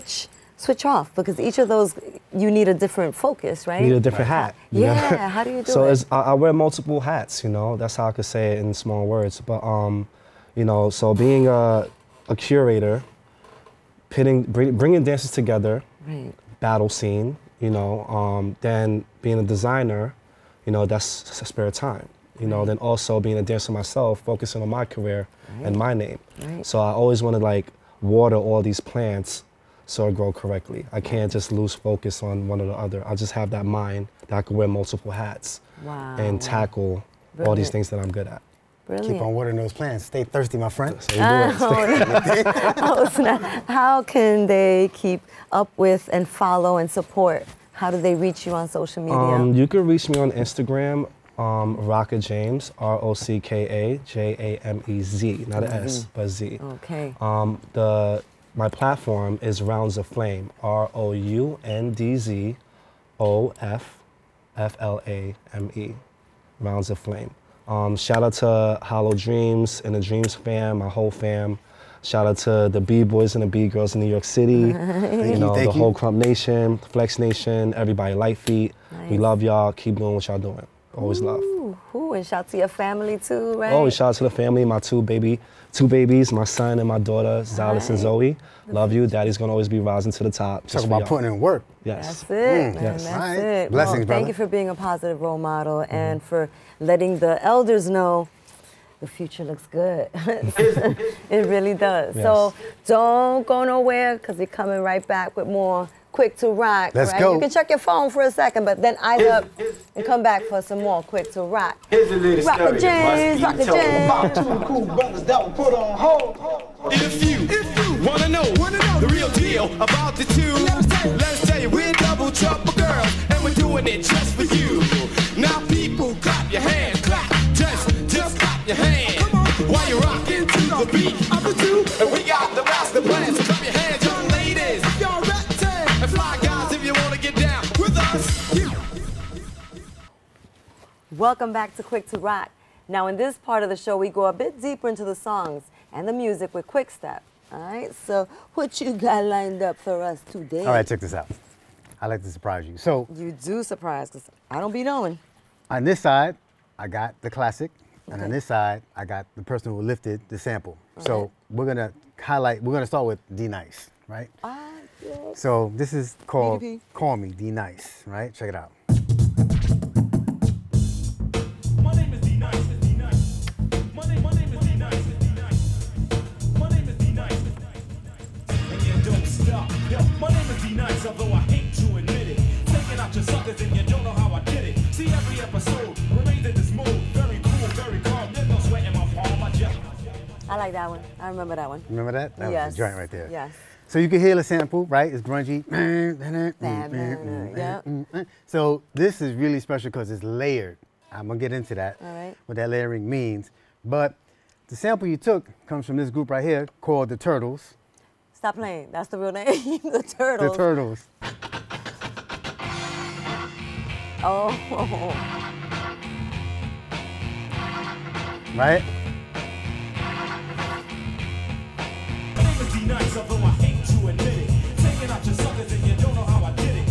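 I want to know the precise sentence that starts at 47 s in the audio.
How do they reach you on social media?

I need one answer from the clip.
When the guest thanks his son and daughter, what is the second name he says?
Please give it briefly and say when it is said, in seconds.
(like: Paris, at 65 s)
Zoe, at 87 s.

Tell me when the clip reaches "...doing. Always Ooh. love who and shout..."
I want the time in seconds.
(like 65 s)
80 s.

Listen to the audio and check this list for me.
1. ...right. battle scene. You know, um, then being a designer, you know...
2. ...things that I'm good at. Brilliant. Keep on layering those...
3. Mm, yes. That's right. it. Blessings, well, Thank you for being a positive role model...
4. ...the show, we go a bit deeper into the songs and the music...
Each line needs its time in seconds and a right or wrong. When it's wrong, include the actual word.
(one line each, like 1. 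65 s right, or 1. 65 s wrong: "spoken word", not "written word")
1. 16 s right
2. 37 s wrong: "watering", not "layering"
3. 92 s right
4. 143 s right.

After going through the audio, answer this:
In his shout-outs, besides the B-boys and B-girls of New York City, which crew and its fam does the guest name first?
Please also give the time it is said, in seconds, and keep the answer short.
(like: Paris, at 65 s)
Hollow Dreams, at 68 s.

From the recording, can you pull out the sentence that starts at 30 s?
I can't just lose focus on one or the other.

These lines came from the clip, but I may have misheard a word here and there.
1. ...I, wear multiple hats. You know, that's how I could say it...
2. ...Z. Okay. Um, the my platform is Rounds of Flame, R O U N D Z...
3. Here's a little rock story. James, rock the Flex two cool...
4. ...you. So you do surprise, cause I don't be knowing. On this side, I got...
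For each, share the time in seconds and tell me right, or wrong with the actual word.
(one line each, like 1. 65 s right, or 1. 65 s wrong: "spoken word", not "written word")
1. 6 s right
2. 56 s right
3. 111 s wrong: "About", not "Flex"
4. 152 s right.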